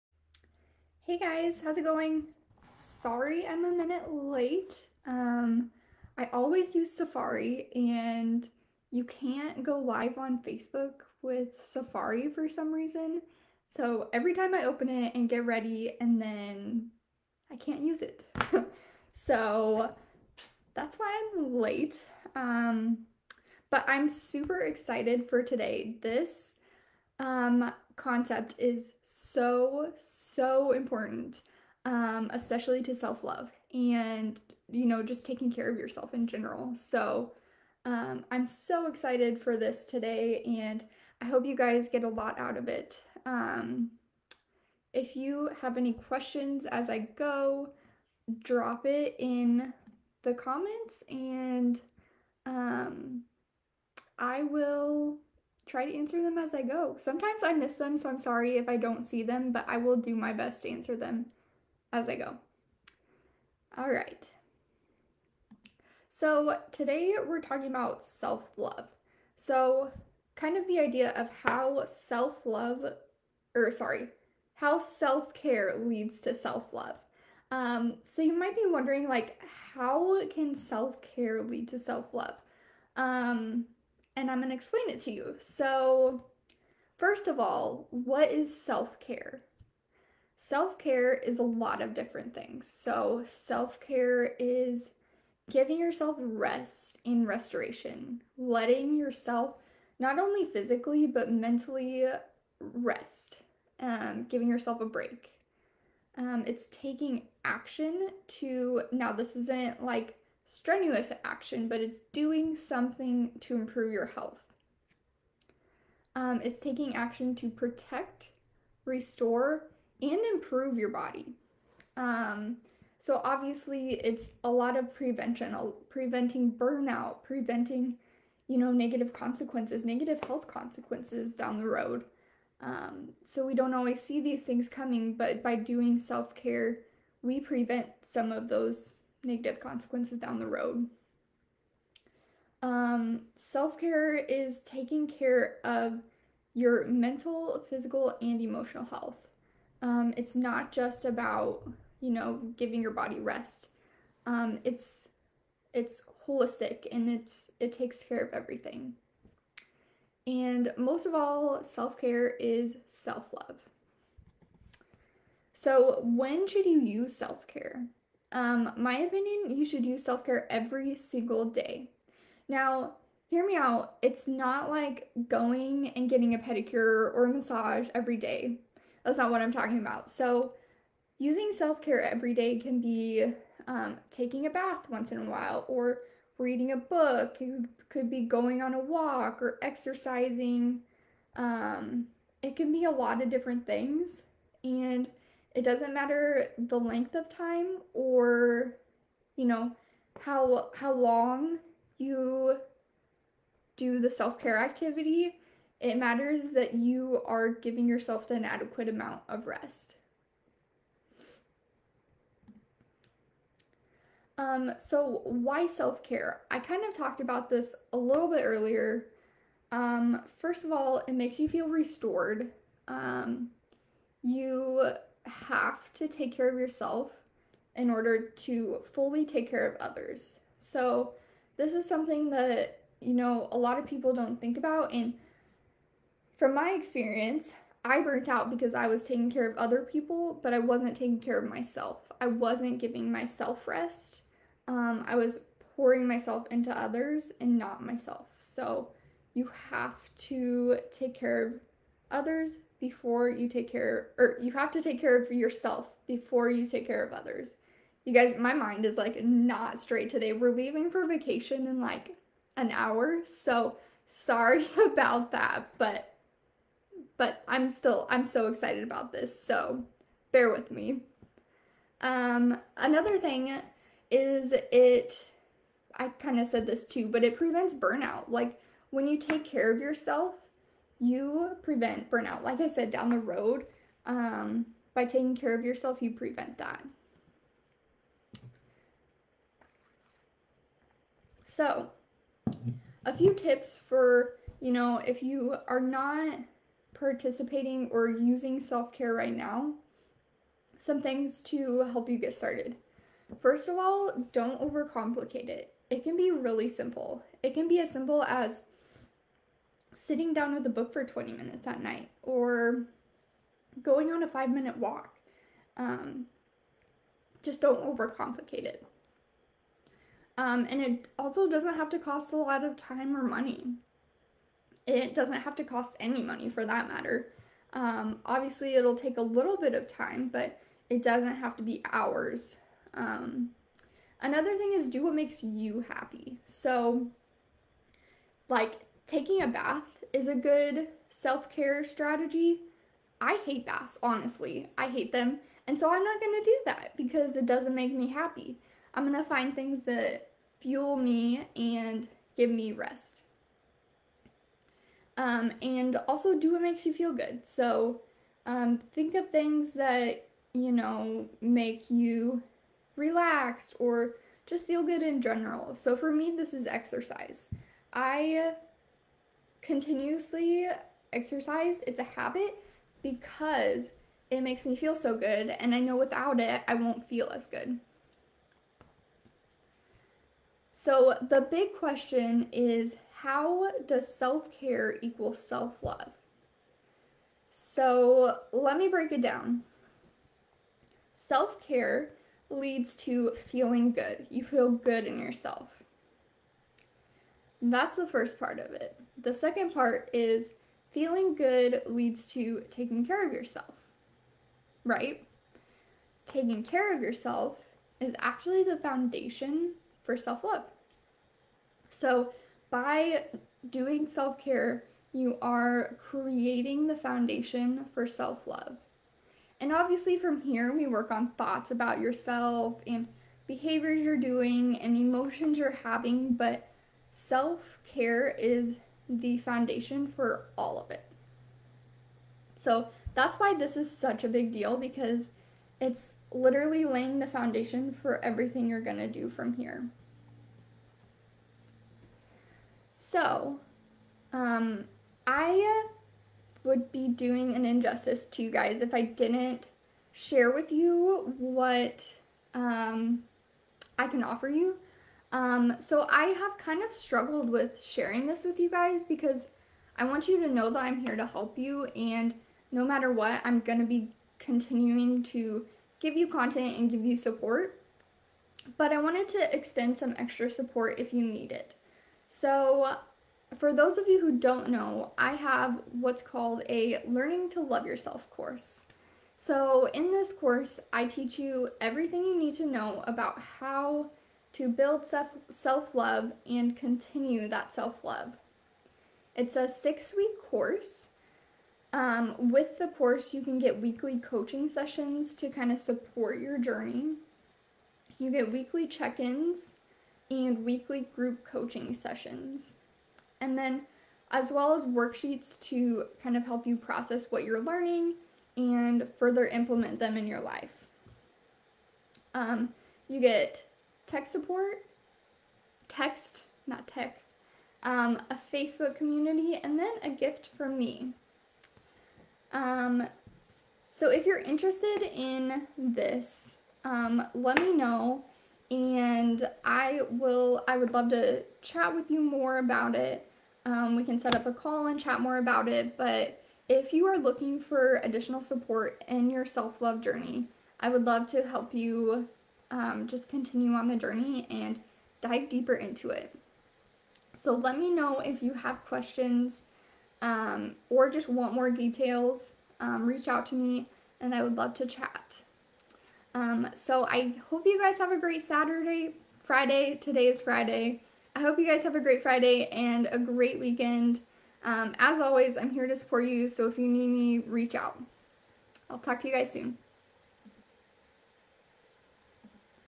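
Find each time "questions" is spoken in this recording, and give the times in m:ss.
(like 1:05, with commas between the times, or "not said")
0:45, 6:21, 9:08.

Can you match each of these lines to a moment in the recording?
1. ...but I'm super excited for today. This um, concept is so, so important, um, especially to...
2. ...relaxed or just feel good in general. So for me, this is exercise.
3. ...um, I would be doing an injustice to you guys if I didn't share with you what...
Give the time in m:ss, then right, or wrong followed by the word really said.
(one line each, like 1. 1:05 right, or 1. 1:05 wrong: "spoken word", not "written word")
1. 0:23 right
2. 6:02 right
3. 7:24 right.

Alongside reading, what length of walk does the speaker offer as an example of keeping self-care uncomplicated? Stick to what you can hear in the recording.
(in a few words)
5 minutes.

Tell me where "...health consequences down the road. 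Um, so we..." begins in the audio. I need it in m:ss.
2:10.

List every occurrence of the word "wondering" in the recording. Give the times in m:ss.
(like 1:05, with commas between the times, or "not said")
1:18.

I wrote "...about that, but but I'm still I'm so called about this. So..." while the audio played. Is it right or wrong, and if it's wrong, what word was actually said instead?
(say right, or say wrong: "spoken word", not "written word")
wrong: "excited", not "called".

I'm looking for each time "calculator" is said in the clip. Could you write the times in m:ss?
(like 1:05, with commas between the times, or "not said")
not said.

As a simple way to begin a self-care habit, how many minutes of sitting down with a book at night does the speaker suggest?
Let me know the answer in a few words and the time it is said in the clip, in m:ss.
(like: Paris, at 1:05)
20, at 5:11.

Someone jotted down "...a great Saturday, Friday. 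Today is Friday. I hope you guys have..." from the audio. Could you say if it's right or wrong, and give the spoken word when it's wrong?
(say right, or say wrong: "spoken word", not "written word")
right.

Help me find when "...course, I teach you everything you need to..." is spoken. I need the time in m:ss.
8:00.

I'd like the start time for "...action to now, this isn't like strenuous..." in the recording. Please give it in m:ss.
1:47.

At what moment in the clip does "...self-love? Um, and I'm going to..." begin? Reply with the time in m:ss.
1:21.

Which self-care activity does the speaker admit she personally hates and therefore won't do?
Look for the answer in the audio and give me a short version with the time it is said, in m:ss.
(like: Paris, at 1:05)
baths, at 5:43.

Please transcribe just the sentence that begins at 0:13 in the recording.
So every time I open it and get ready and then I can't use it.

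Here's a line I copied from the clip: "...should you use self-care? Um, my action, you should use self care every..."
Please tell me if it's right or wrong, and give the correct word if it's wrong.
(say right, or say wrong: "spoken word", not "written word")
wrong: "opinion", not "action".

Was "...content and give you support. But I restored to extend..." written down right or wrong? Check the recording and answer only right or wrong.
wrong.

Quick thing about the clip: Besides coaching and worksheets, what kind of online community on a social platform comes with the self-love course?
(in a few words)
Facebook community.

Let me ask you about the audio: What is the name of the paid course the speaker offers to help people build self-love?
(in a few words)
Learning to Love Yourself.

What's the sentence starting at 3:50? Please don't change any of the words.
So, this is something that, you know, a lot of people don't think about.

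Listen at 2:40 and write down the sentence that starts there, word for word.
And most of all, self-care is self-love.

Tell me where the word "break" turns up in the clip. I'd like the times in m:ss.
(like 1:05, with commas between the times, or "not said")
1:44, 6:28.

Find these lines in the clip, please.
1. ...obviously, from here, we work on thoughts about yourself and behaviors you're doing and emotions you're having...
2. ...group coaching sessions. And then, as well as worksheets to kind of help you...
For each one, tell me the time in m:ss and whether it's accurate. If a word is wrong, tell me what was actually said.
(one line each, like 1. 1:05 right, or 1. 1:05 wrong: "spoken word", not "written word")
1. 6:59 right
2. 8:21 right.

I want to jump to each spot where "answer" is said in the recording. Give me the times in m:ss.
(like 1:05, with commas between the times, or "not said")
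0:55, 1:00.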